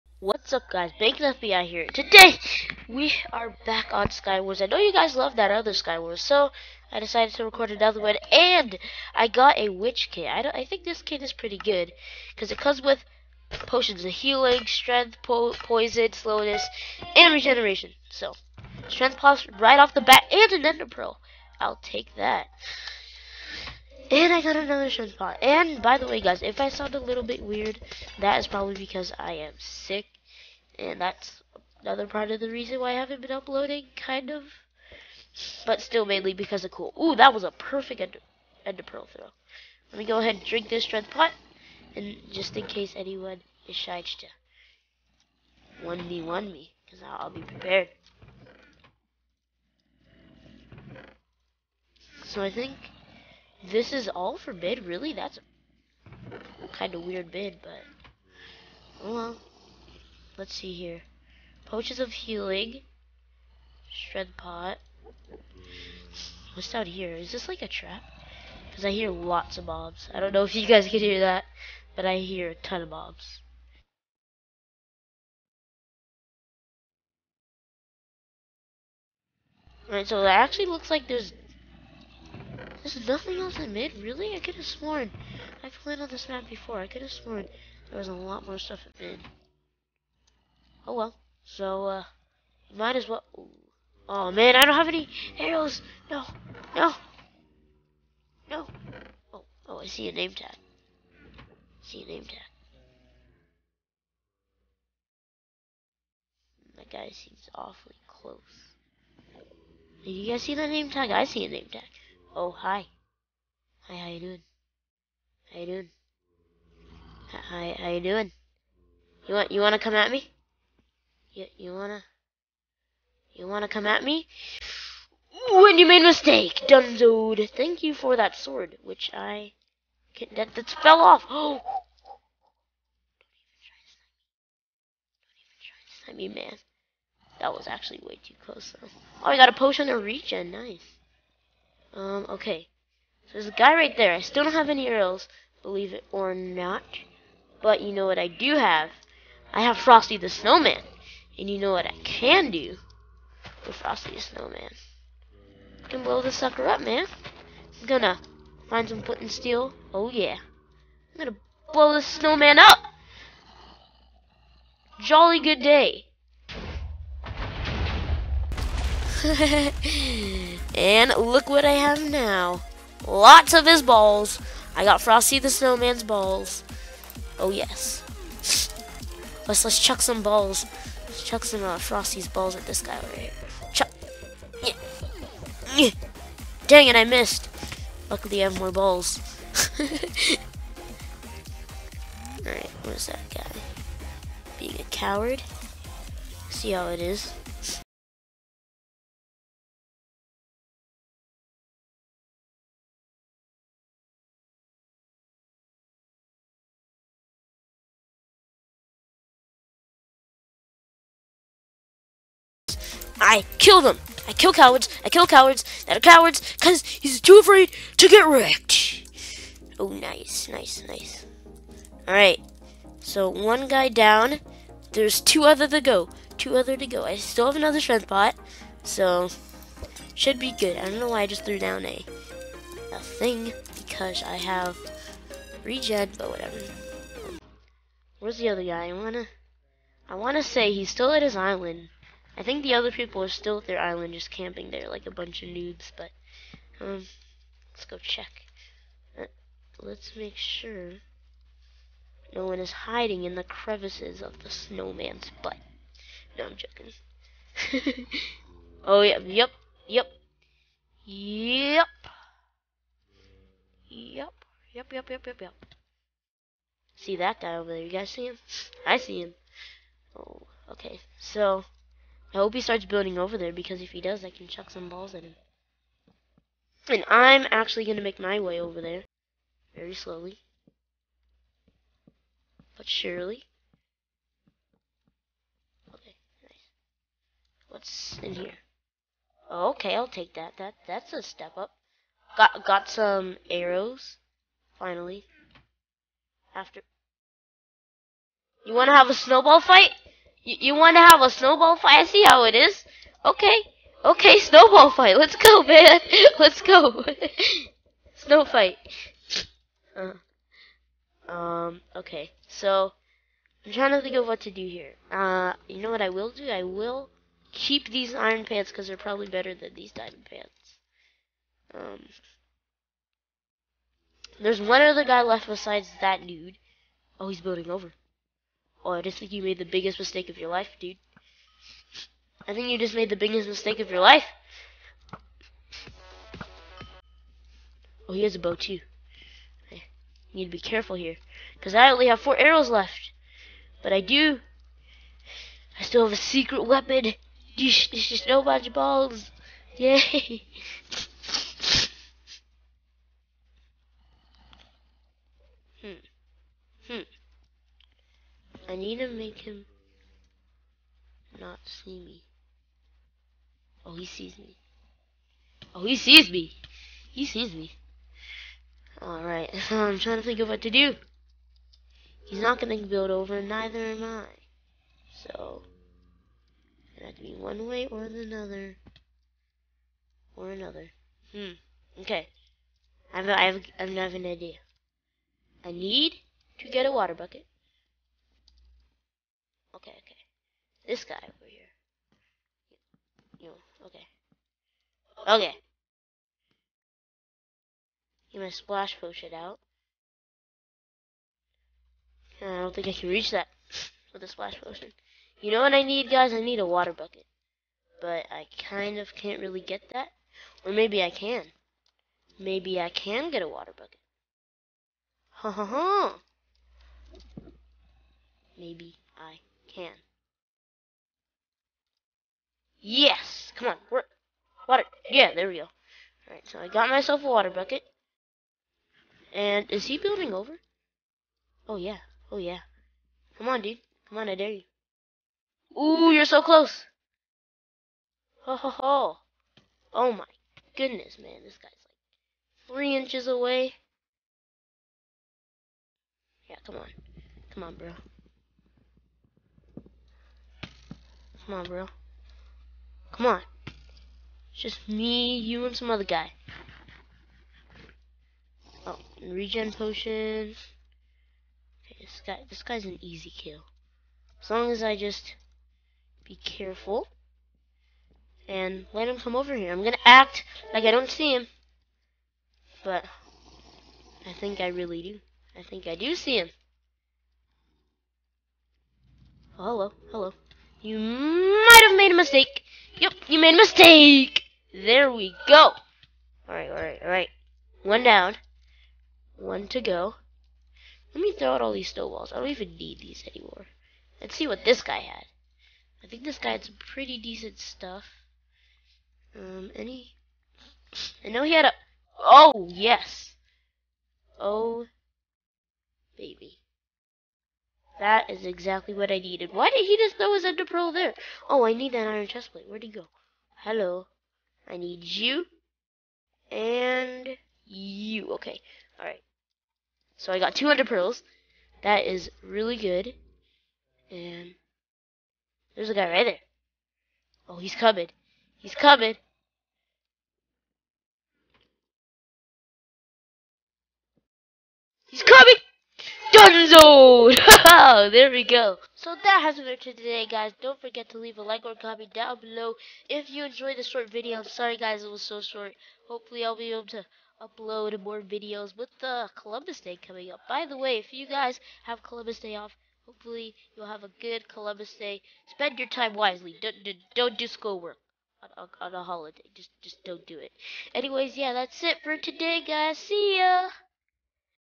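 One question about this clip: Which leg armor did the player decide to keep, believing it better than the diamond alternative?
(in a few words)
Iron pants.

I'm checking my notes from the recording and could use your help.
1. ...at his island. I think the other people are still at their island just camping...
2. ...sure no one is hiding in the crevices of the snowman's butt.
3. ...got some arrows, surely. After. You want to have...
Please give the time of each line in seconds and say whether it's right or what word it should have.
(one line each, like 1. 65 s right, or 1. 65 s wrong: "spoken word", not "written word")
1. 241 s right
2. 250 s right
3. 292 s wrong: "finally", not "surely".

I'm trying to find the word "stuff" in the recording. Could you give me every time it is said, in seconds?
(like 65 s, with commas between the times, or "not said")
88 s, 497 s.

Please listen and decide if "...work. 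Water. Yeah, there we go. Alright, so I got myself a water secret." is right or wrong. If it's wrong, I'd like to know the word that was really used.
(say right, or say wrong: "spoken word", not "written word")
wrong: "bucket", not "secret".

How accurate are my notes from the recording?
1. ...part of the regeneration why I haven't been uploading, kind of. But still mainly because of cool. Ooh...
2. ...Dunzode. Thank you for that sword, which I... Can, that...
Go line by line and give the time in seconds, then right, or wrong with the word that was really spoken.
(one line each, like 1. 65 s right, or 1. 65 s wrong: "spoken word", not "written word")
1. 32 s wrong: "reason", not "regeneration"
2. 126 s right.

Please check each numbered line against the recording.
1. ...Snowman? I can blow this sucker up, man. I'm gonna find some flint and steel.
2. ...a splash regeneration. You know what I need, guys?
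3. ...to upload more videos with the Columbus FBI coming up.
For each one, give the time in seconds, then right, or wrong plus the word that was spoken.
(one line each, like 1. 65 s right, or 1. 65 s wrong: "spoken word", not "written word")
1. 154 s right
2. 404 s wrong: "potion", not "regeneration"
3. 546 s wrong: "Day", not "FBI".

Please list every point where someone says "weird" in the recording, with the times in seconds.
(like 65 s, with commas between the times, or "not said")
27 s, 57 s.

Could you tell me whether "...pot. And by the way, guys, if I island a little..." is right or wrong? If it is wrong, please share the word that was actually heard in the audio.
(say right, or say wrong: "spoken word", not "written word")
wrong: "sound", not "island".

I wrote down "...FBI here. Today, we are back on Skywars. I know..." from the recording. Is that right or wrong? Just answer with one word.
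right.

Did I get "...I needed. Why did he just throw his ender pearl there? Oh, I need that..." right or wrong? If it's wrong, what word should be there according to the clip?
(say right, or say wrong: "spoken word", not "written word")
right.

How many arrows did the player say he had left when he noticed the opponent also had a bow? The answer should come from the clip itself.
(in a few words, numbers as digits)
4.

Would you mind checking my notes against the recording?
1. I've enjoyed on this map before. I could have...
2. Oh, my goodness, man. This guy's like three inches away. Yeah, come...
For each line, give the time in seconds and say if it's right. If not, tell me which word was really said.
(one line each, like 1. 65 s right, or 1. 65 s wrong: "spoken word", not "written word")
1. 85 s wrong: "played", not "enjoyed"
2. 439 s right.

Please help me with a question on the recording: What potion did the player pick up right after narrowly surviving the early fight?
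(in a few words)
Regeneration.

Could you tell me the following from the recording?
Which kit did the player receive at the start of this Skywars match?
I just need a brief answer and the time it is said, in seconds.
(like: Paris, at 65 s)
Witch kit, at 9 s.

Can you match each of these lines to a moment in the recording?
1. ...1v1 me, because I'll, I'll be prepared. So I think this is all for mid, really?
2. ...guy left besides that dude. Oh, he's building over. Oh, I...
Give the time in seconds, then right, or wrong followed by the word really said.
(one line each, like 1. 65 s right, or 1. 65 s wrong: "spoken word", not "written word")
1. 45 s right
2. 325 s right.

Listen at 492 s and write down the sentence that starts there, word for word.
I don't even need these anymore.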